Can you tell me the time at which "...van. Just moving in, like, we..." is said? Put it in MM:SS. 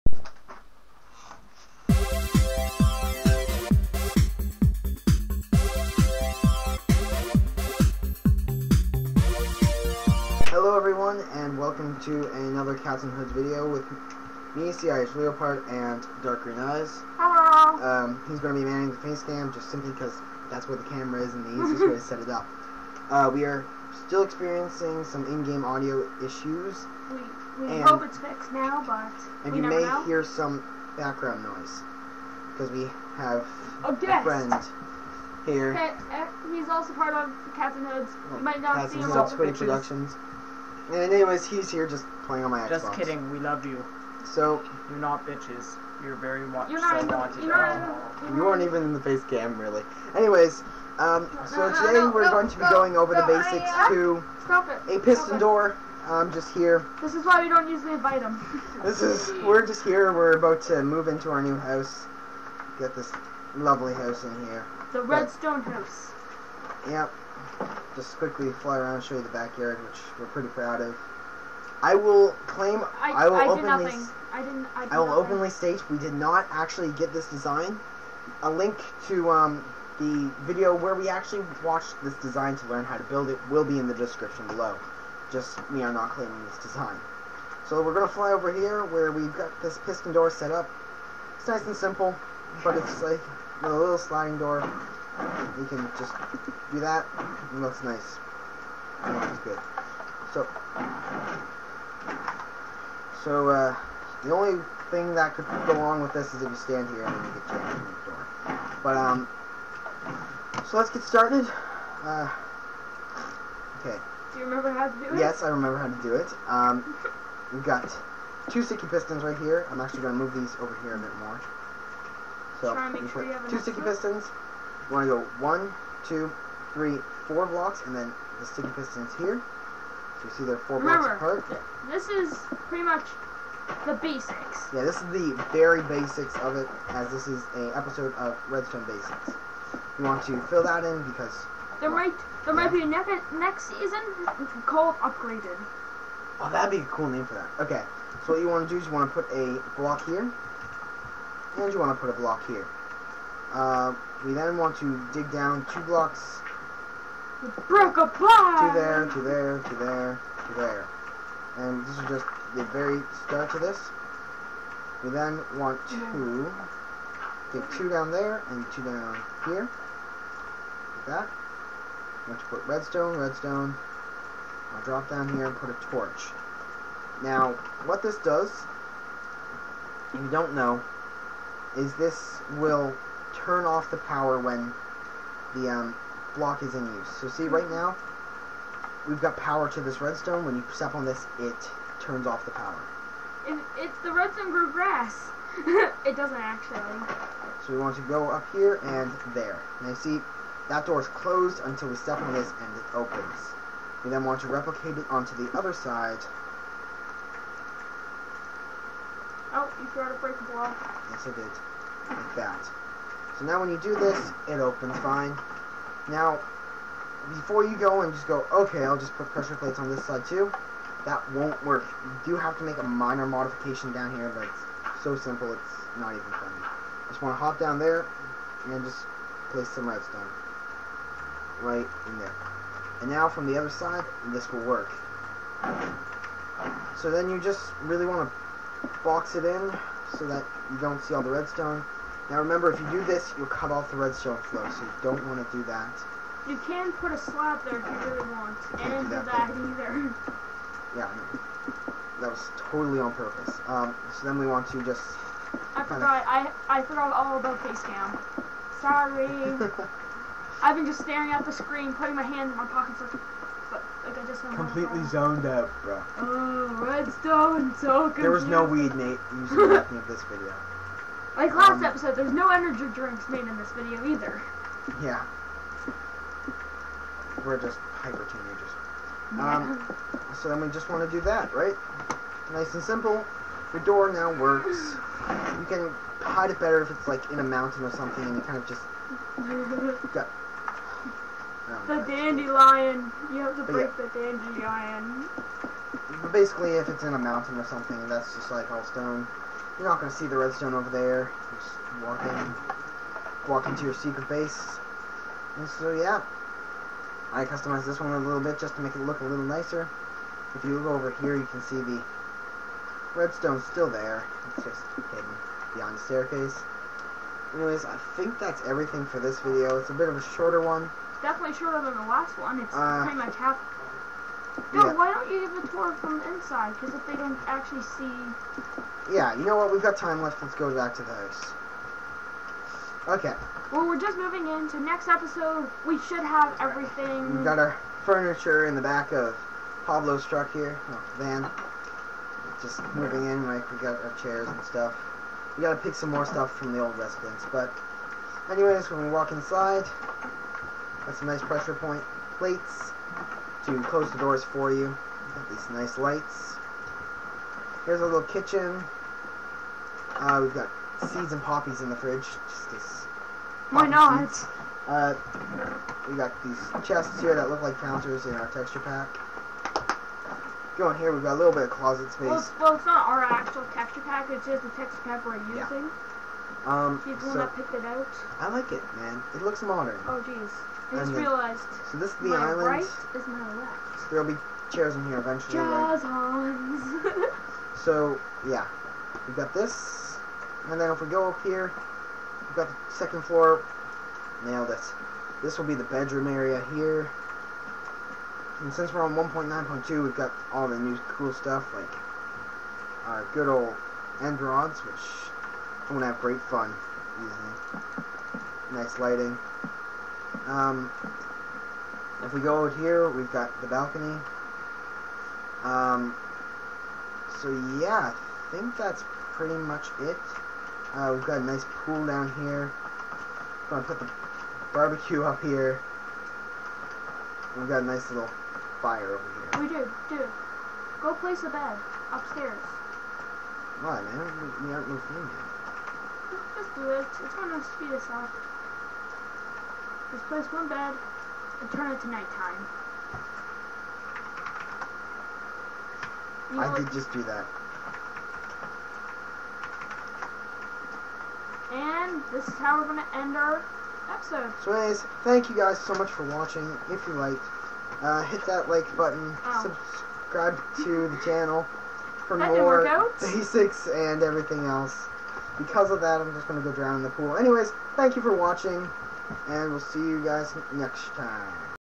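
05:41.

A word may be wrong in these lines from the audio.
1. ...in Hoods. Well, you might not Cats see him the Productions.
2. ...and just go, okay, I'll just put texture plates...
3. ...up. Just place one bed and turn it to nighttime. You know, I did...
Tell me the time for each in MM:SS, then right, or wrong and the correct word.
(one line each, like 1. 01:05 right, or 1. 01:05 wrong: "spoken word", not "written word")
1. 00:37 right
2. 03:38 wrong: "pressure", not "texture"
3. 07:18 right.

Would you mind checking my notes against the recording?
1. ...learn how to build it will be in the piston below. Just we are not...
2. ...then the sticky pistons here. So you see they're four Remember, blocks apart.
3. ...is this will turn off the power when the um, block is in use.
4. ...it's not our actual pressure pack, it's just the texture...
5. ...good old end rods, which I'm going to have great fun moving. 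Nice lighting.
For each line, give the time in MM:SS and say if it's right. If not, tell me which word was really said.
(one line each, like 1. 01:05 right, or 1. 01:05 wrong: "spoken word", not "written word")
1. 01:22 wrong: "description", not "piston"
2. 02:07 right
3. 03:01 right
4. 06:12 wrong: "texture", not "pressure"
5. 06:43 wrong: "using", not "moving".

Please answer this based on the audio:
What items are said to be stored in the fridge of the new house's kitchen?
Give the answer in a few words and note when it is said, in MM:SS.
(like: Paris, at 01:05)
seeds and poppies, at 06:01.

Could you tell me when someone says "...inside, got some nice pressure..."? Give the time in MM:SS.
05:49.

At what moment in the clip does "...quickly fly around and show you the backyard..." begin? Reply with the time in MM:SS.
01:08.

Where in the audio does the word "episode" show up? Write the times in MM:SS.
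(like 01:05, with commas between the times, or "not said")
02:17, 04:31, 05:35, 07:34.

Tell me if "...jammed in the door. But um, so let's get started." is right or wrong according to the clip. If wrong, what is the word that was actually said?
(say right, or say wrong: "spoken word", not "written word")
right.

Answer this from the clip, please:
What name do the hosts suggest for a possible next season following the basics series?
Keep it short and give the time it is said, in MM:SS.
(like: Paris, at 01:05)
Upgraded, at 02:24.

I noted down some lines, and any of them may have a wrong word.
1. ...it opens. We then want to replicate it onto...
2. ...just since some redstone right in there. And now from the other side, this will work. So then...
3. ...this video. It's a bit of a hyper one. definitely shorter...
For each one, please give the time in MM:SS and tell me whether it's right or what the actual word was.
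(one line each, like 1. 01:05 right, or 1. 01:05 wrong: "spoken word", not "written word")
1. 03:22 right
2. 03:48 wrong: "place", not "since"
3. 05:19 wrong: "shorter", not "hyper".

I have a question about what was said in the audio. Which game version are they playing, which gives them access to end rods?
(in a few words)
1.9.2.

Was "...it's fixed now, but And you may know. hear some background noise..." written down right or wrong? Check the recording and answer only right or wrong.
right.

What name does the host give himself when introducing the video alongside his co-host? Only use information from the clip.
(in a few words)
the Irish Leopard.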